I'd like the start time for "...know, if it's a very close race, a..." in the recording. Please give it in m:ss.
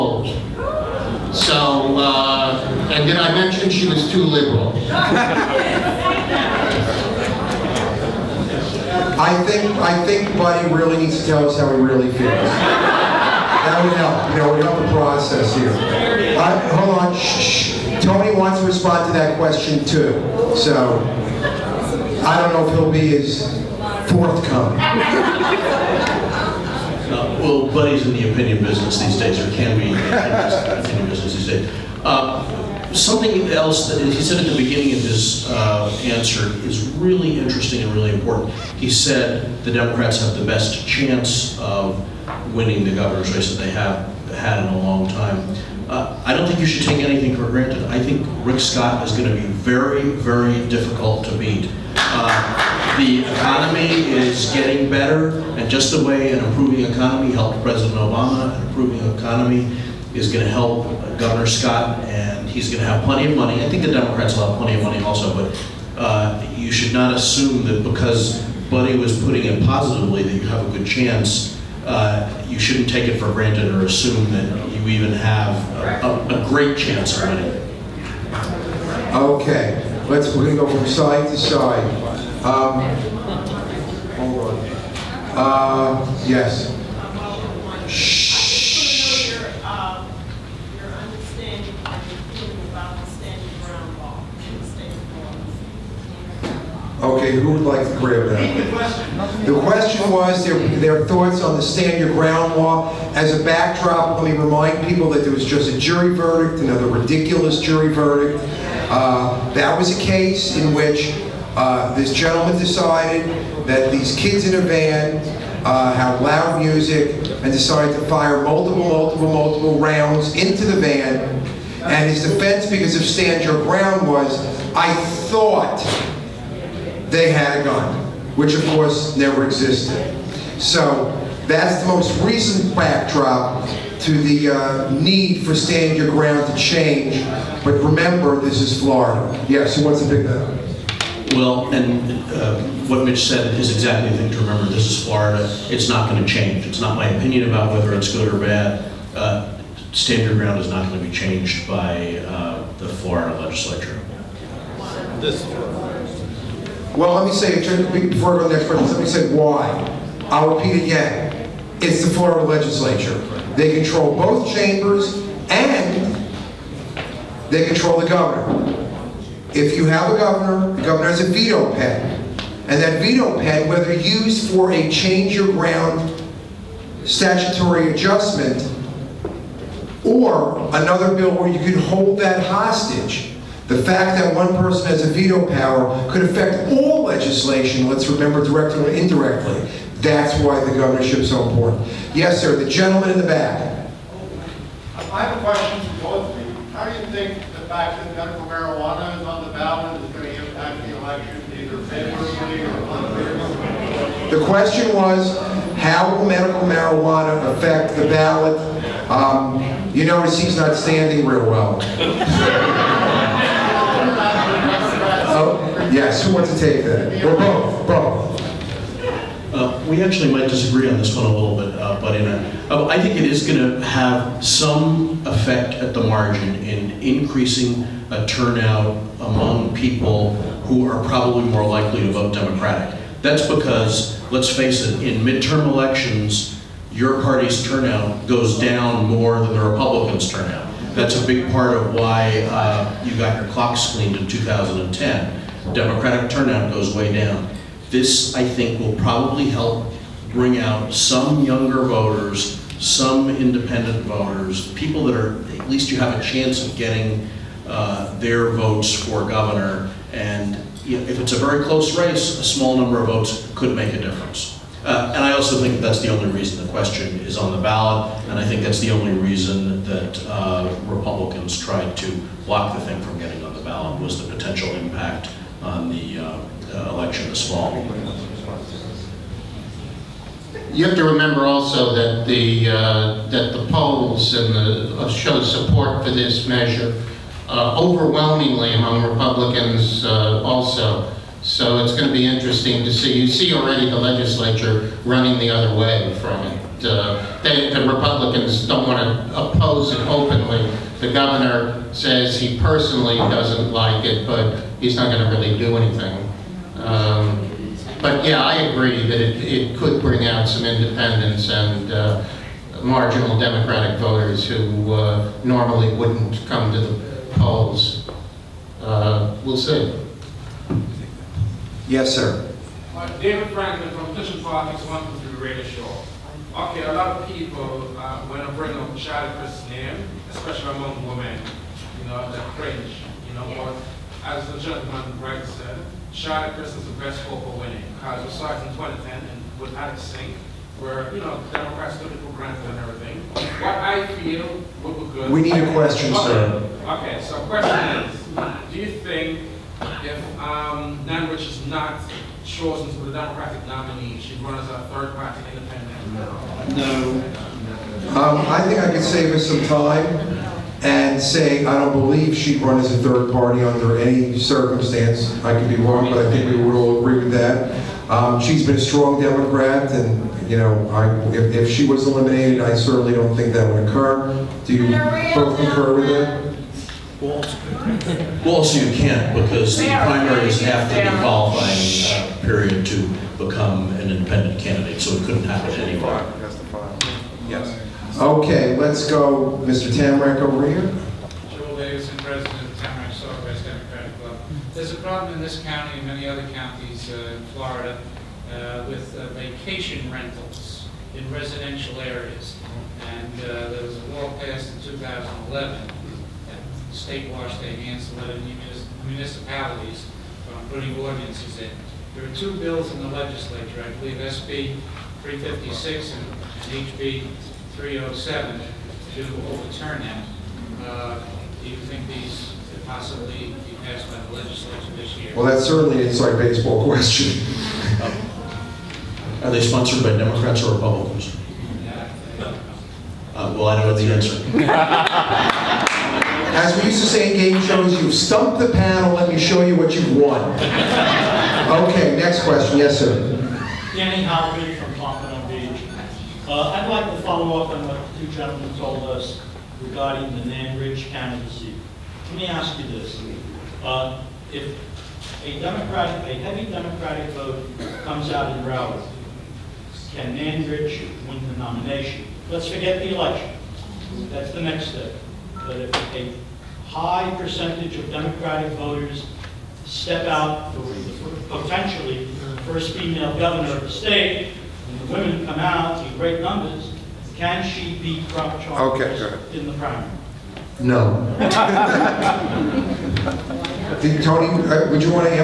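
4:20.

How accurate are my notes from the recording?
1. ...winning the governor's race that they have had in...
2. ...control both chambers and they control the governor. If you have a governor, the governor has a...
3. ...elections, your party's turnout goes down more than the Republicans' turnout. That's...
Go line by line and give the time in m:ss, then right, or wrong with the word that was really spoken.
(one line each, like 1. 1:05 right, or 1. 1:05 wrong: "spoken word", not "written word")
1. 0:42 right
2. 2:43 right
3. 3:55 right.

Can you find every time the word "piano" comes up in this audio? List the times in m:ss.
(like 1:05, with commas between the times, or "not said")
not said.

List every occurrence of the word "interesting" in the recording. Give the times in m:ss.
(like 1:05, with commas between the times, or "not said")
0:37, 4:52.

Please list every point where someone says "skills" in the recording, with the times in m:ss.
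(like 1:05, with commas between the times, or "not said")
not said.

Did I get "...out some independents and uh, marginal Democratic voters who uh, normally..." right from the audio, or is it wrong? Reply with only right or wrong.
right.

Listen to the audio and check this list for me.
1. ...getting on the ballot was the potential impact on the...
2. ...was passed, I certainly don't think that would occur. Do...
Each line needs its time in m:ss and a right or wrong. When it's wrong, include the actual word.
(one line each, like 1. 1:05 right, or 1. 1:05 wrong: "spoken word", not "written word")
1. 4:33 right
2. 6:11 wrong: "eliminated", not "passed".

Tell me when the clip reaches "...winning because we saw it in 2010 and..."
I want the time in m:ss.
5:37.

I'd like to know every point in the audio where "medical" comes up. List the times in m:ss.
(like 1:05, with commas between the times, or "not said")
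3:18, 3:26.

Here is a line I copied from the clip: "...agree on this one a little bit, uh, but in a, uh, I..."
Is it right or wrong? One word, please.
wrong.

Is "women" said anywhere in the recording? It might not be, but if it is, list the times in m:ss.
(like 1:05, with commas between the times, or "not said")
5:31, 7:55.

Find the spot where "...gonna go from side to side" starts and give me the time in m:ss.
1:20.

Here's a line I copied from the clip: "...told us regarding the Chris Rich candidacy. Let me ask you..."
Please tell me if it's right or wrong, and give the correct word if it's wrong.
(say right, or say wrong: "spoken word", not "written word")
wrong: "Nan", not "Chris".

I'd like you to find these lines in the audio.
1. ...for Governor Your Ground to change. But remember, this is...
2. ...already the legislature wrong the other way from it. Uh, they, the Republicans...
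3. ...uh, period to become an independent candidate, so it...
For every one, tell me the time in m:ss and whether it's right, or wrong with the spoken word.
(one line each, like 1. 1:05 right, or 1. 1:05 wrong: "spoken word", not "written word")
1. 2:15 wrong: "Stand", not "Governor"
2. 4:53 wrong: "running", not "wrong"
3. 6:22 right.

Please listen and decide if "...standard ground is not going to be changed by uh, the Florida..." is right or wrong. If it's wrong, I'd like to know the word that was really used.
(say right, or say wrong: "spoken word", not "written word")
right.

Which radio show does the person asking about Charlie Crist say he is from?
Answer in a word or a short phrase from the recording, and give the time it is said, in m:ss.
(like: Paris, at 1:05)
Kitchen one London, at 5:24.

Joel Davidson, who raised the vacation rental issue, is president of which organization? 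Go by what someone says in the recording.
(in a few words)
the Democratic Club.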